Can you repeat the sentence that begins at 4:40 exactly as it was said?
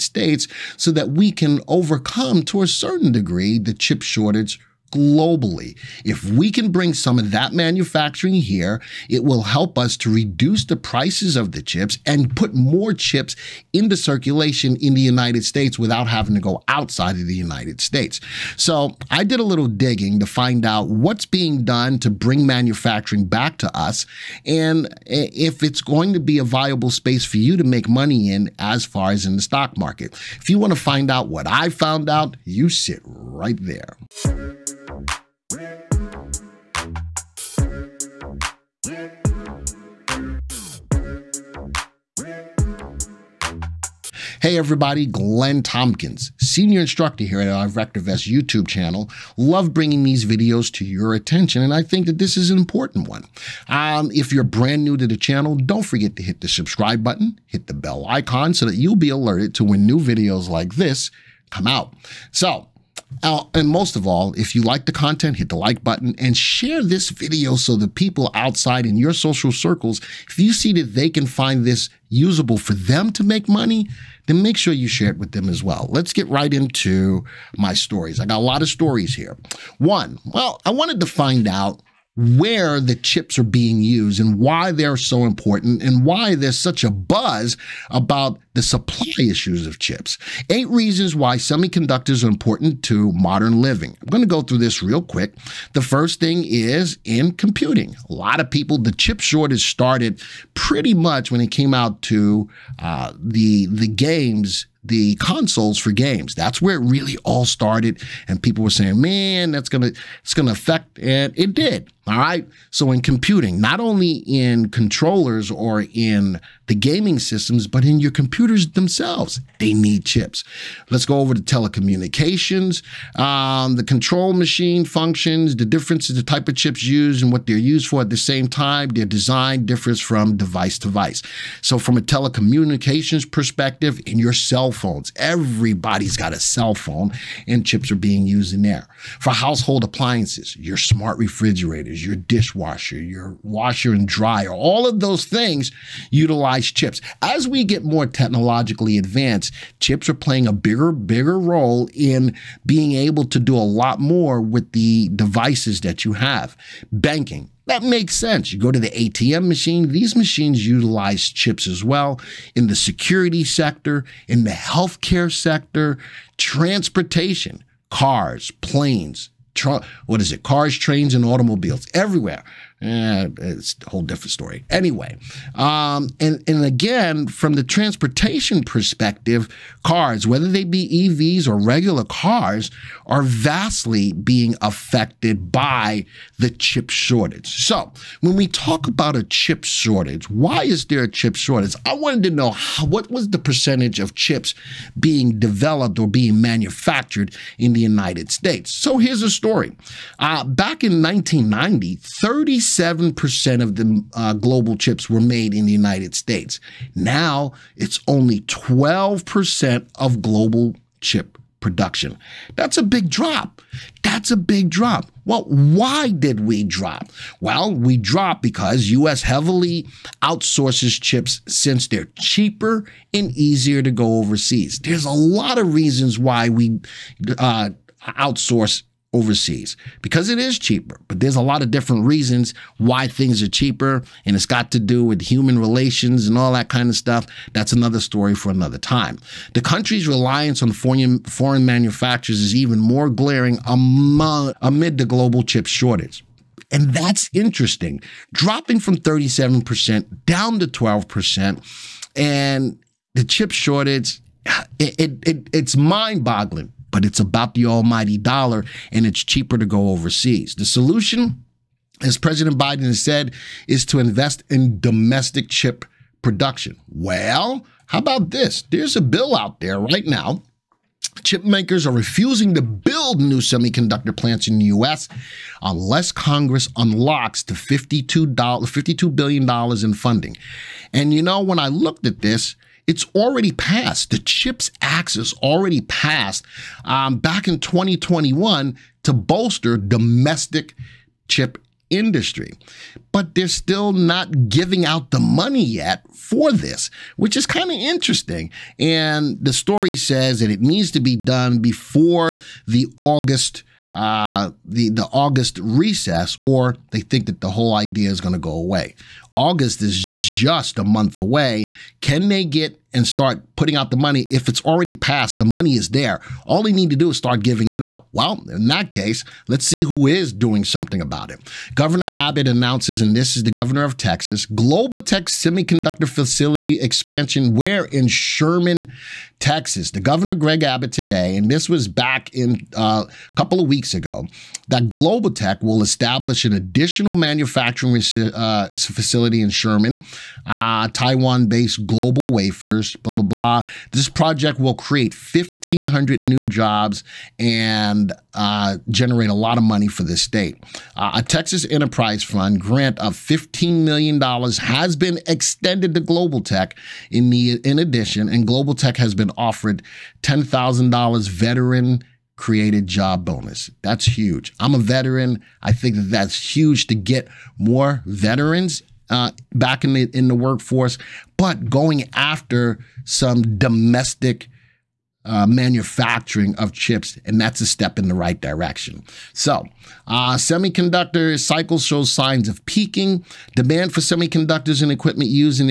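And you know, when I looked at this, it's already passed.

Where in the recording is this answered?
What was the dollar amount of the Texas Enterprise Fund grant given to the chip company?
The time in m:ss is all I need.
5:53.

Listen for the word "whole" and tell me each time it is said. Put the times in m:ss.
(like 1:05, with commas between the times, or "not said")
2:53, 5:07.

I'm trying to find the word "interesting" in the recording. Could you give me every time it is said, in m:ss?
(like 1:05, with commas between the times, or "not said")
4:07, 4:57.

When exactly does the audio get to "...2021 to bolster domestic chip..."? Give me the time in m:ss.
4:47.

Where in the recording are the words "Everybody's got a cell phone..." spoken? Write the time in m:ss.
2:15.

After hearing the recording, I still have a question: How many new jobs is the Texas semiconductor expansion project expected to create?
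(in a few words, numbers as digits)
1,500.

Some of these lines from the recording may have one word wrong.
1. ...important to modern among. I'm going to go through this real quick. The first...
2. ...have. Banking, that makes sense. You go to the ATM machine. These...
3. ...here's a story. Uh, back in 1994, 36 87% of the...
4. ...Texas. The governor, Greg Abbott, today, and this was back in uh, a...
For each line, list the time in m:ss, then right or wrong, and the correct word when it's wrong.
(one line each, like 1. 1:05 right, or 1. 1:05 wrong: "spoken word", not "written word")
1. 1:32 wrong: "living", not "among"
2. 2:36 right
3. 3:18 wrong: "1990", not "1994"
4. 5:29 right.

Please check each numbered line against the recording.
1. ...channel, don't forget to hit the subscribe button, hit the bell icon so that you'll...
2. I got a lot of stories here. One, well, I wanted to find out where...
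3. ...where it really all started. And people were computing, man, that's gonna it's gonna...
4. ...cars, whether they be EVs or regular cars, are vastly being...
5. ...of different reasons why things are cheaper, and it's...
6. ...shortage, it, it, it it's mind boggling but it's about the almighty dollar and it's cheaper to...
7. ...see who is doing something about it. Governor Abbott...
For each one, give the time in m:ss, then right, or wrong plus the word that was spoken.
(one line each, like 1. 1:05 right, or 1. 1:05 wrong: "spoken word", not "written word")
1. 0:55 right
2. 1:18 right
3. 1:46 wrong: "saying", not "computing"
4. 2:59 right
5. 3:51 right
6. 4:13 right
7. 5:19 right.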